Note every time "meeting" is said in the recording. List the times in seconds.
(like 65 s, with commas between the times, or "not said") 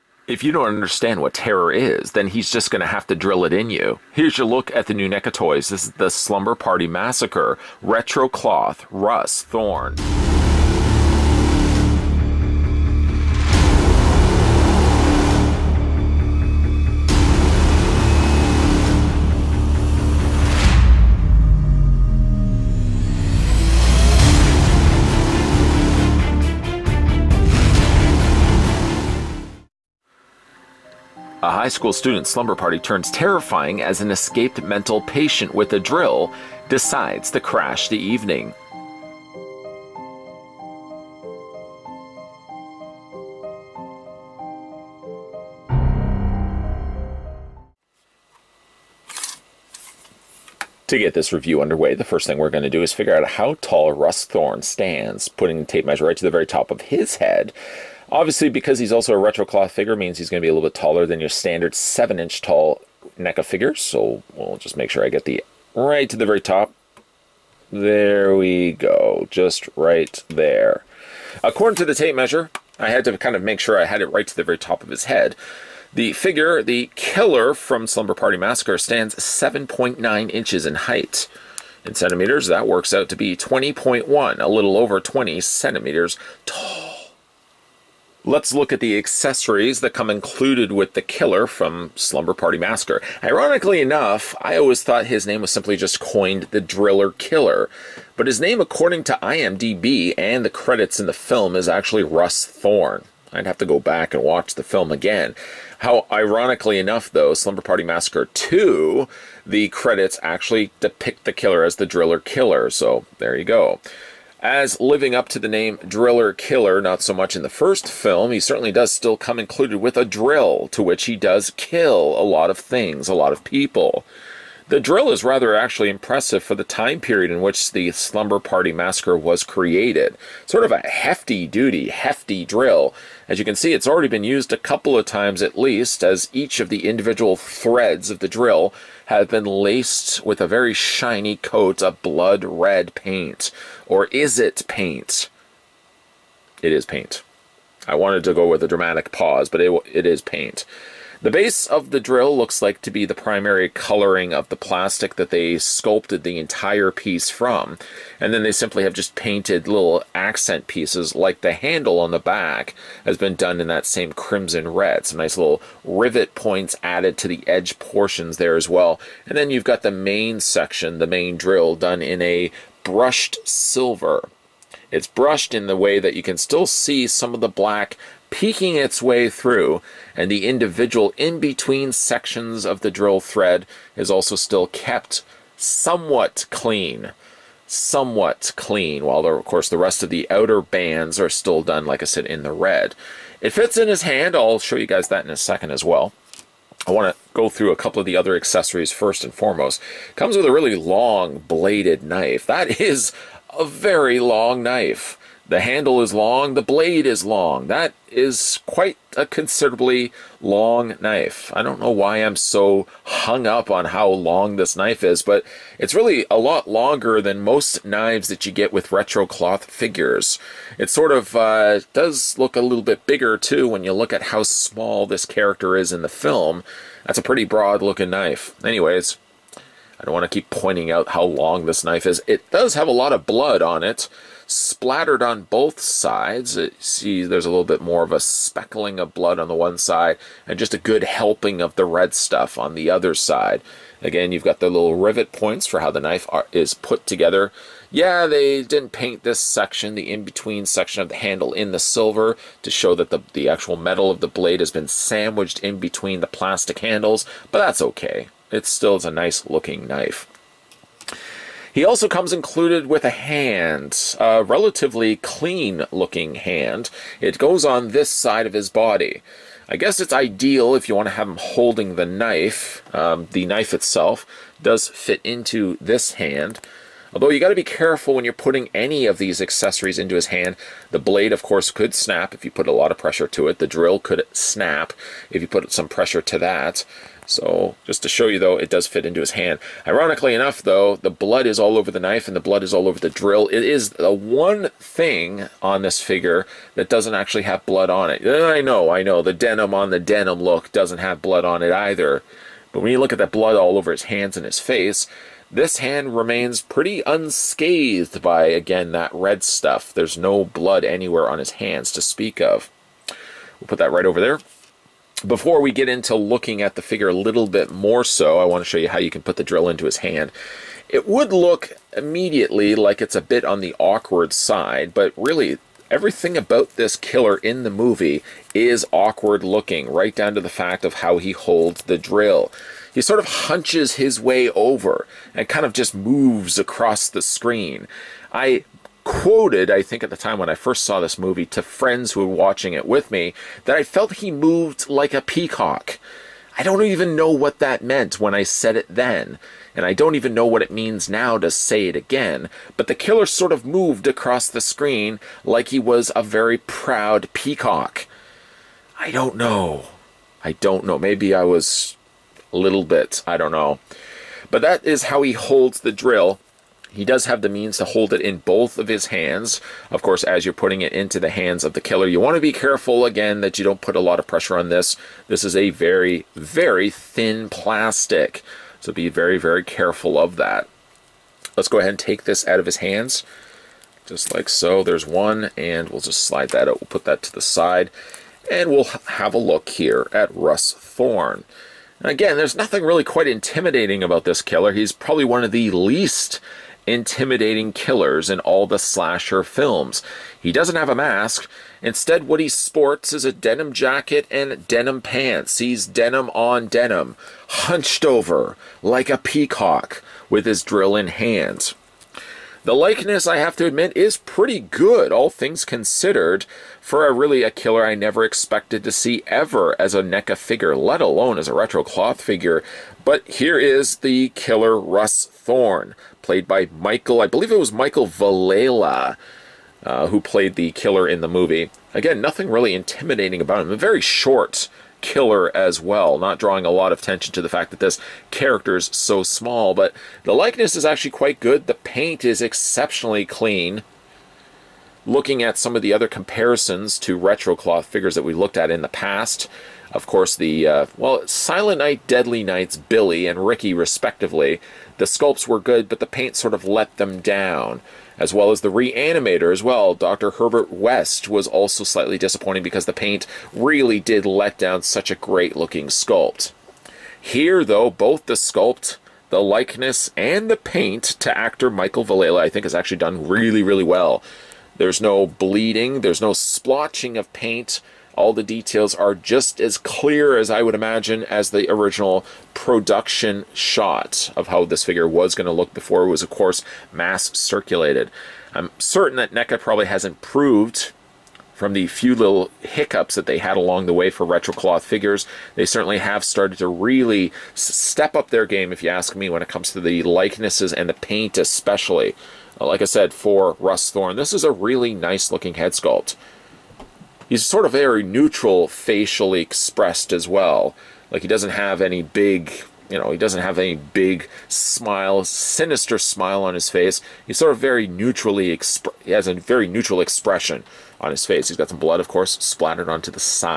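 not said.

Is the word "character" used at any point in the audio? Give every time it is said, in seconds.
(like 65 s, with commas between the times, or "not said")
225 s, 438 s.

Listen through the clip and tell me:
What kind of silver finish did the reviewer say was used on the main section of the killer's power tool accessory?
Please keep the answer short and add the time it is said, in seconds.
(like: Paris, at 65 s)
brushed silver, at 172 s.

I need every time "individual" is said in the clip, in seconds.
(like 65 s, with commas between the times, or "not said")
136 s, 180 s.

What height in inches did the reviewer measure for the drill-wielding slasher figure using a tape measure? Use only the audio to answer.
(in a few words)
7.9 inches.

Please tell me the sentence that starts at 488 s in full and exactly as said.
I'm certain that NECA probably has improved from the few little hiccups that they had along the way for retro cloth figures.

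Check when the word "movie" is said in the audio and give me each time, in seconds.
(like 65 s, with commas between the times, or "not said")
327 s, 341 s, 431 s.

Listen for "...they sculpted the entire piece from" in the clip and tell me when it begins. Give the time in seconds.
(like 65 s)
155 s.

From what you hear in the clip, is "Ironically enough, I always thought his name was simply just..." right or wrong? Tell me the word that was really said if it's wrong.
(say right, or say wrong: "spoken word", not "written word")
right.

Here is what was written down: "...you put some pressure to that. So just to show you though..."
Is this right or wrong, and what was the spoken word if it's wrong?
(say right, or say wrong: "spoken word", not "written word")
right.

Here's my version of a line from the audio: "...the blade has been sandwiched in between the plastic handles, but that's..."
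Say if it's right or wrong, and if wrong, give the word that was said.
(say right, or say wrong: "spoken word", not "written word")
right.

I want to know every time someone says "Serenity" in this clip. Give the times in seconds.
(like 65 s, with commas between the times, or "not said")
not said.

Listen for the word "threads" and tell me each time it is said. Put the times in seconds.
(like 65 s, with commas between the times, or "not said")
137 s, 183 s.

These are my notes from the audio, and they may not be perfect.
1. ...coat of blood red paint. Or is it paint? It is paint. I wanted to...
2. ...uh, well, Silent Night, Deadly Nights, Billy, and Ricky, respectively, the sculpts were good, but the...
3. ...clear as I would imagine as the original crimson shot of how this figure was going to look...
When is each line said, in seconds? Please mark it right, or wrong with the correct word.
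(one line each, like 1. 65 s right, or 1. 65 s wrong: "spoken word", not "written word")
1. 141 s right
2. 450 s right
3. 479 s wrong: "production", not "crimson".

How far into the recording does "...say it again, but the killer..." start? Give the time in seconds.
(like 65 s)
351 s.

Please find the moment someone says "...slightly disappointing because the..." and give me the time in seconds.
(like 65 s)
461 s.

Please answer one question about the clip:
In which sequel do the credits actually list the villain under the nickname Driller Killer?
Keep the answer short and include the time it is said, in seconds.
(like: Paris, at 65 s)
Slumber Party Massacre 2, at 107 s.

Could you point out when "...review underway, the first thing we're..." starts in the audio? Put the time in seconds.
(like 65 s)
51 s.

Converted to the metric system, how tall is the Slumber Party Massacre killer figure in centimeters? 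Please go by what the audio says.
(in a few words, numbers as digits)
20.1.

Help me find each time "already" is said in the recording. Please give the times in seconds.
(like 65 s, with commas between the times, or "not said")
133 s.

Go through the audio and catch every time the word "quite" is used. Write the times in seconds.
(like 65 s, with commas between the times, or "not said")
208 s, 393 s, 441 s.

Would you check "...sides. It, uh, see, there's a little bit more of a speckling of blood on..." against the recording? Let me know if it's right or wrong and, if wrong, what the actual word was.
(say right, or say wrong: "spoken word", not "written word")
right.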